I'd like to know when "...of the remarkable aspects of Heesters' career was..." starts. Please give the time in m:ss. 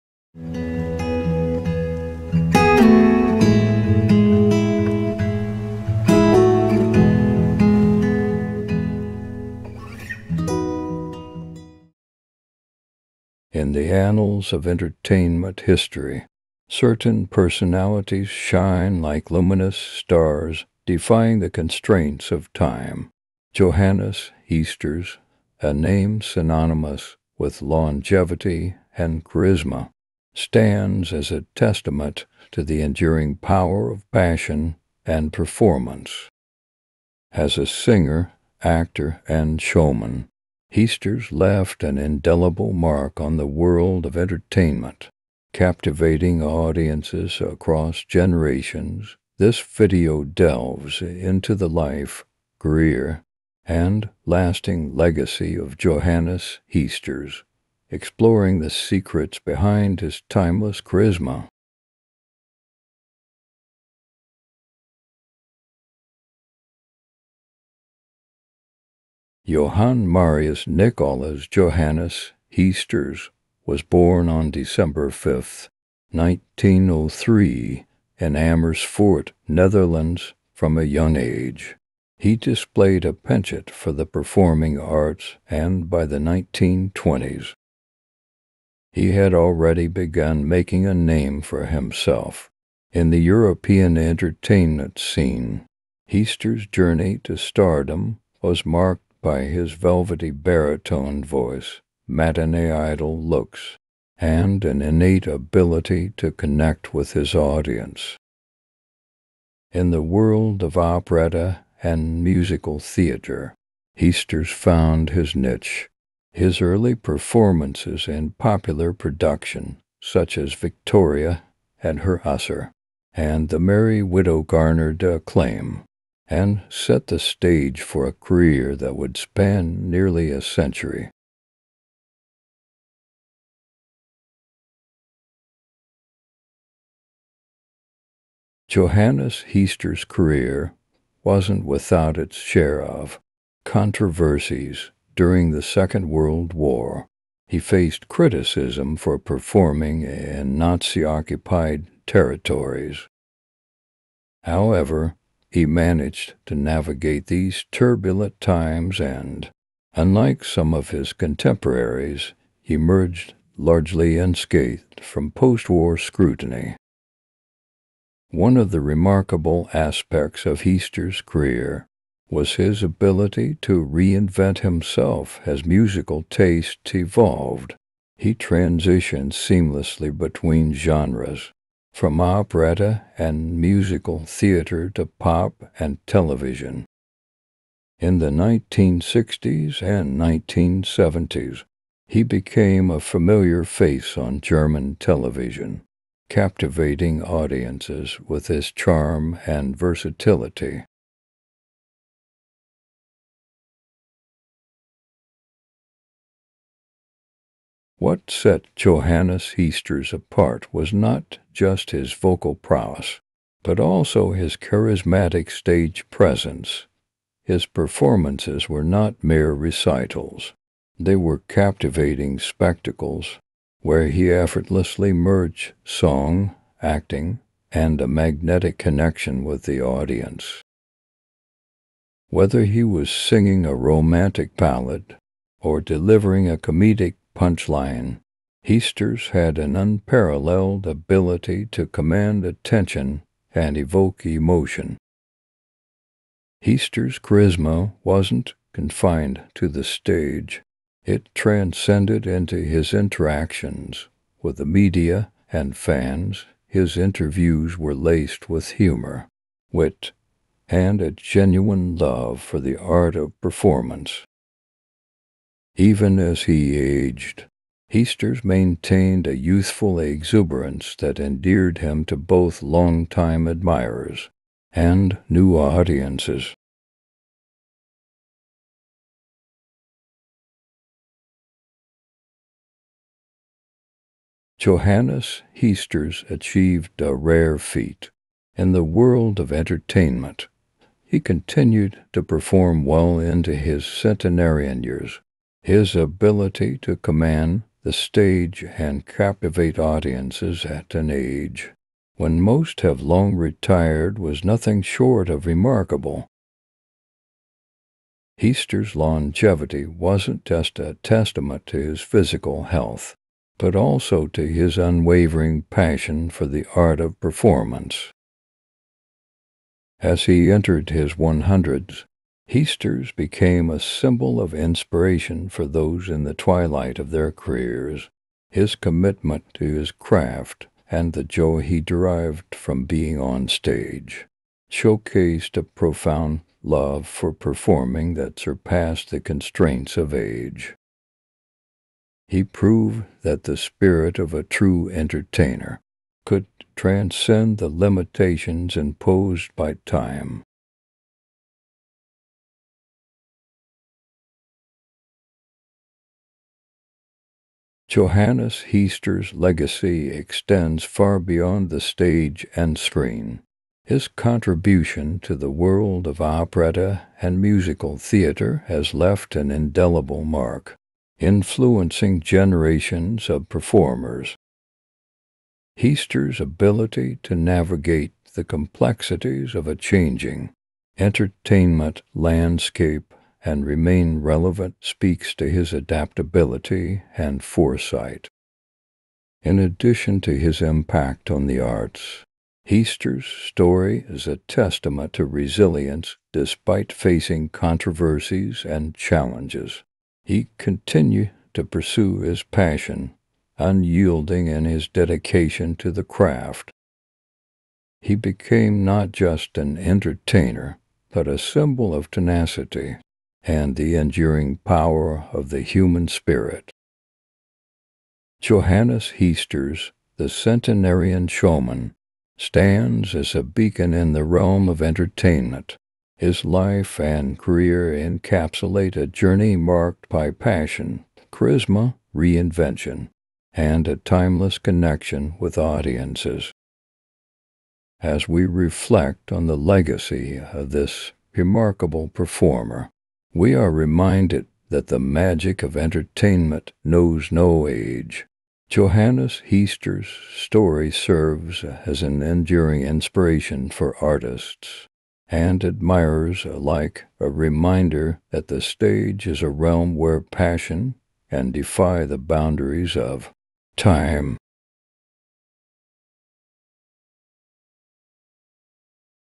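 2:48.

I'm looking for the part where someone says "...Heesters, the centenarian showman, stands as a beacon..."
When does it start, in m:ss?
6:59.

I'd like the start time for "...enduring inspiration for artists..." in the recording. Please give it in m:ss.
7:32.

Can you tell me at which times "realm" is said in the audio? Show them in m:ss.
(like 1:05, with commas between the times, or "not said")
7:04, 7:39.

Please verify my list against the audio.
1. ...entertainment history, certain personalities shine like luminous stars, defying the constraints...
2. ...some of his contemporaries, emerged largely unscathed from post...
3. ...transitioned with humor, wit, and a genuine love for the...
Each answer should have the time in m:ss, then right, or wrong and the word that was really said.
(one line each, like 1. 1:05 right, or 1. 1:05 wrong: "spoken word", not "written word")
1. 0:14 right
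2. 2:40 right
3. 4:17 wrong: "laced", not "transitioned".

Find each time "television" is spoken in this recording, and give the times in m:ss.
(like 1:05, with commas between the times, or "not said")
3:06, 3:14.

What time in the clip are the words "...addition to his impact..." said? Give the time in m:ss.
6:29.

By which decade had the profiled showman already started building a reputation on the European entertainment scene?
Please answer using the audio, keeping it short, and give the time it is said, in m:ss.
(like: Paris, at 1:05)
1920s, at 1:26.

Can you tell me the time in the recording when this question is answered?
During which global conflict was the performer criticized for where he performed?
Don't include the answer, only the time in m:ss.
2:25.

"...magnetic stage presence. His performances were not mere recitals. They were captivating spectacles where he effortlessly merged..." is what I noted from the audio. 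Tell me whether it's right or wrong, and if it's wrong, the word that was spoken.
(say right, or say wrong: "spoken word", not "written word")
wrong: "charismatic", not "magnetic".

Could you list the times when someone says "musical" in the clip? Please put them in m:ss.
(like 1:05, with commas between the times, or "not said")
1:52, 2:55, 3:03, 6:07.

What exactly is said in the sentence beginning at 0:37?
As a singer, actor, and showman, Heesters left an indelible mark on the world of entertainment, captivating audiences across generations.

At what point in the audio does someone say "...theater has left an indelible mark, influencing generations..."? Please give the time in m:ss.
6:07.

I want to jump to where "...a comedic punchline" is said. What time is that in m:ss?
3:56.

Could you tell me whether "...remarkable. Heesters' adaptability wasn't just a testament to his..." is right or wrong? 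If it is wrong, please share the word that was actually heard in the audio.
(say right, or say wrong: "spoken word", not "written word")
wrong: "longevity", not "adaptability".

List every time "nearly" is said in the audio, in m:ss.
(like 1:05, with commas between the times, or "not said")
2:09.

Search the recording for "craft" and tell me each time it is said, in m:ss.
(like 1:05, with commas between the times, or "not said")
5:29, 6:46.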